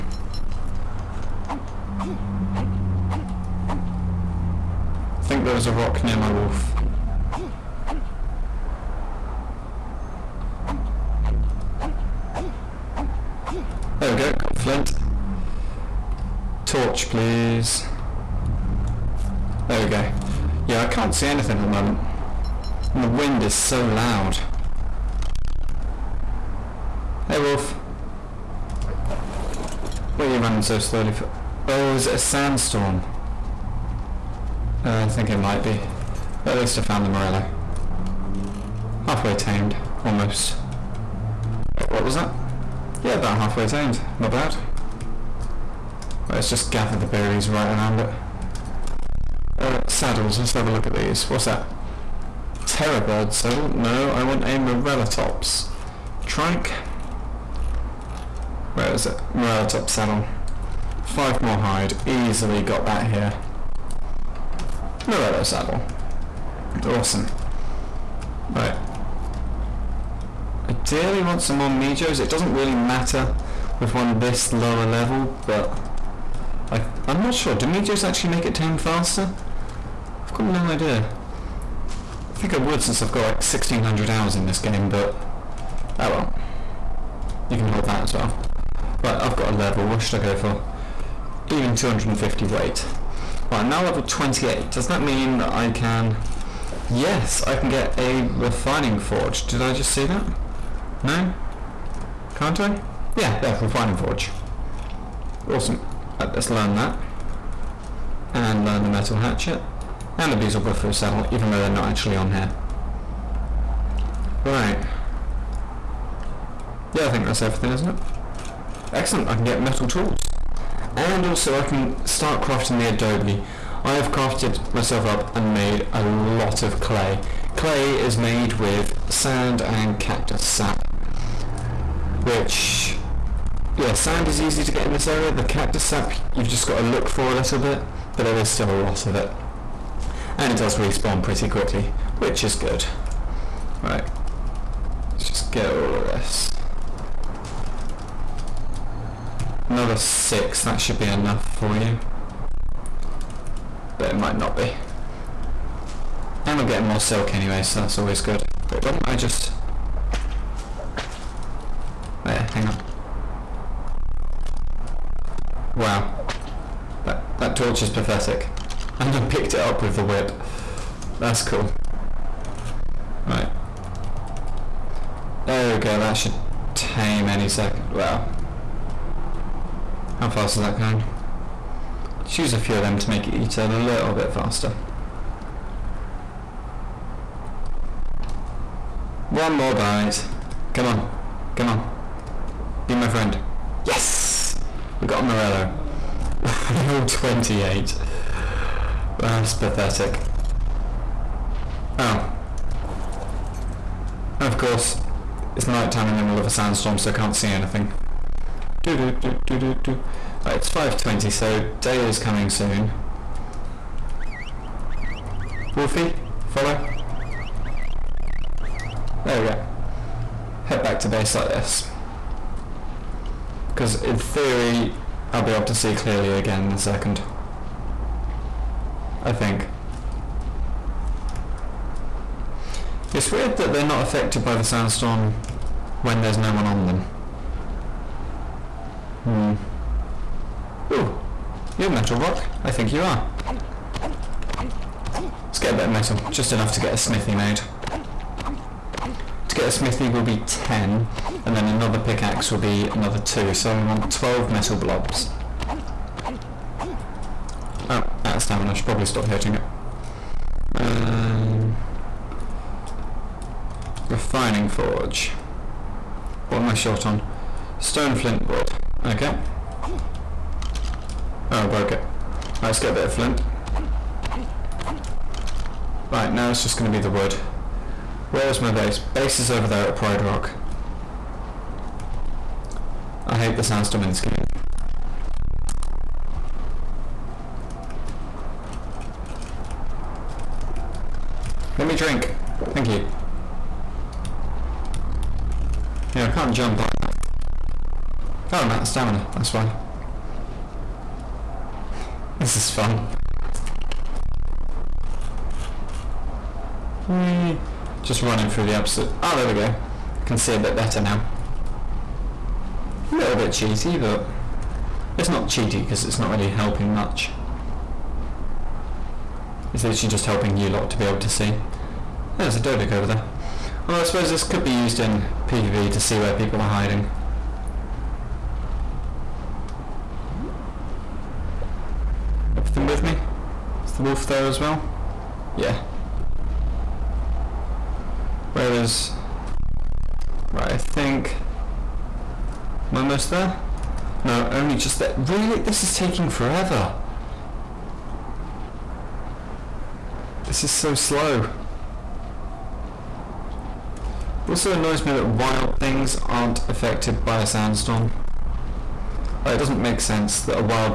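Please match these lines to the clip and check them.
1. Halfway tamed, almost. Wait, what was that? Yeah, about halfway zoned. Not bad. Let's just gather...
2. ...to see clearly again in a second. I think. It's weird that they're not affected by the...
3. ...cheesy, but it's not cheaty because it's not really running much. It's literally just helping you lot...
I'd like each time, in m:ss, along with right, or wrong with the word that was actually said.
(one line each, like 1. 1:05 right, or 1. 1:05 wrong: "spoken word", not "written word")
1. 0:39 right
2. 3:45 right
3. 5:13 wrong: "helping", not "running".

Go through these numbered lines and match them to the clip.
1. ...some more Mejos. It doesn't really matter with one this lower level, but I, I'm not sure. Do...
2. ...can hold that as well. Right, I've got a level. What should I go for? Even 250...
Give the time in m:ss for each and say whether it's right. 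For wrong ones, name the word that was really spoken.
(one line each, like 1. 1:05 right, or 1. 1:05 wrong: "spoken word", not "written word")
1. 1:11 right
2. 1:27 right.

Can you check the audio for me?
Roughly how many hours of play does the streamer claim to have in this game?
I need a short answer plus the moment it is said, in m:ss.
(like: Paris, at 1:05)
1600, at 1:23.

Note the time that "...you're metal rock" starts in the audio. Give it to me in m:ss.
4:01.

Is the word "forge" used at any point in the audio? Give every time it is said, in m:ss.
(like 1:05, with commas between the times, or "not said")
1:38, 1:43, 4:24.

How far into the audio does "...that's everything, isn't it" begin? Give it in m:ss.
1:57.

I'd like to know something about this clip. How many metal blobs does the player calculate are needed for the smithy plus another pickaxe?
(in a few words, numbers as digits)
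12.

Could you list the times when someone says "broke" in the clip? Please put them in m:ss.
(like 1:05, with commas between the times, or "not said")
4:31.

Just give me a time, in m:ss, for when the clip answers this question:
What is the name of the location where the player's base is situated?
4:39.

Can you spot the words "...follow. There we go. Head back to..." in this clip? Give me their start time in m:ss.
3:36.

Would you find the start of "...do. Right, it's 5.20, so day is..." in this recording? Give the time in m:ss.
3:29.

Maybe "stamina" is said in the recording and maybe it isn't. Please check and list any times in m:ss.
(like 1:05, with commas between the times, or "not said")
4:18, 4:58.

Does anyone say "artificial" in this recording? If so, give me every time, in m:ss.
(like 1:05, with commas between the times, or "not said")
not said.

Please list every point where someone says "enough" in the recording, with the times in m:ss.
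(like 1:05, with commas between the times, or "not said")
2:31, 4:06.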